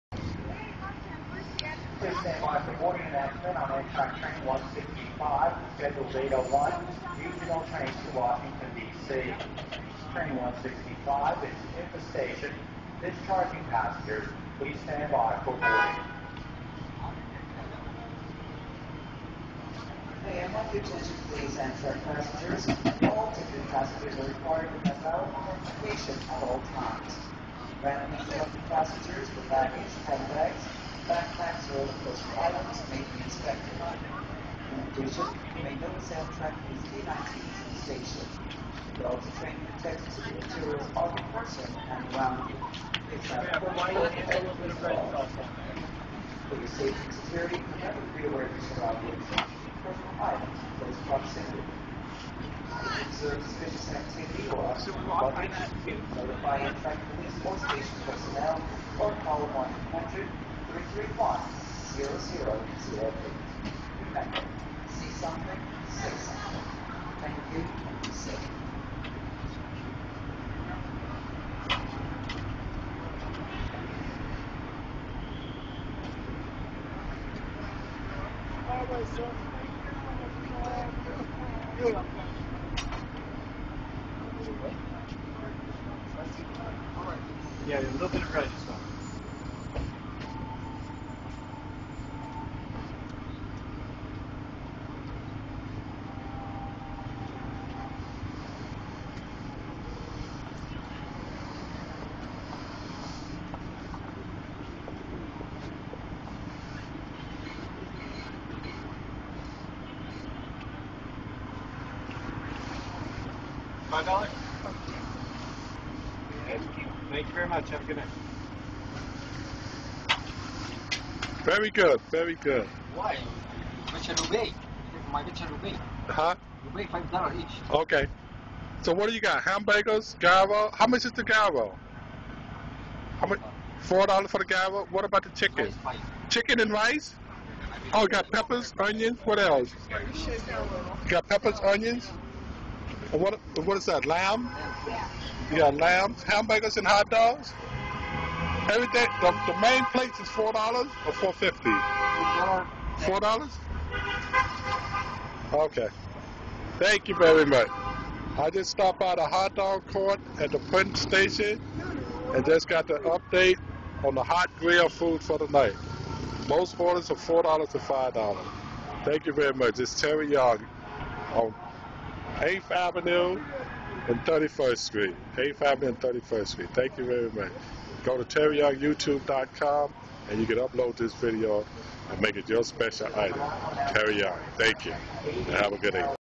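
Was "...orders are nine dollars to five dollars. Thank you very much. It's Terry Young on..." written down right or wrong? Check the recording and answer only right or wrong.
wrong.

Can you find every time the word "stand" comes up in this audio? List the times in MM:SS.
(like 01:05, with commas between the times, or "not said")
00:02, 00:14.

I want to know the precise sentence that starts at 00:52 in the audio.
If you observe suspicious activity or observe notify Amtrak police or station personnel.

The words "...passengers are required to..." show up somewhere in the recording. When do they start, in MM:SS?
00:23.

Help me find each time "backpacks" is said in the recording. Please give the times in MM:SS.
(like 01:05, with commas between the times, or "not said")
00:31.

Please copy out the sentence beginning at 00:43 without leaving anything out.
It's not For your safety and security, never be aware of your surroundings.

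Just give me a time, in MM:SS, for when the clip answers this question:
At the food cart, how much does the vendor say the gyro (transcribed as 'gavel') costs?
02:13.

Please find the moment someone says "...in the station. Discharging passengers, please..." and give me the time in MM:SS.
00:11.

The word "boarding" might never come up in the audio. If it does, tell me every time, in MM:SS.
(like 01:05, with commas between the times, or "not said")
00:02, 00:15.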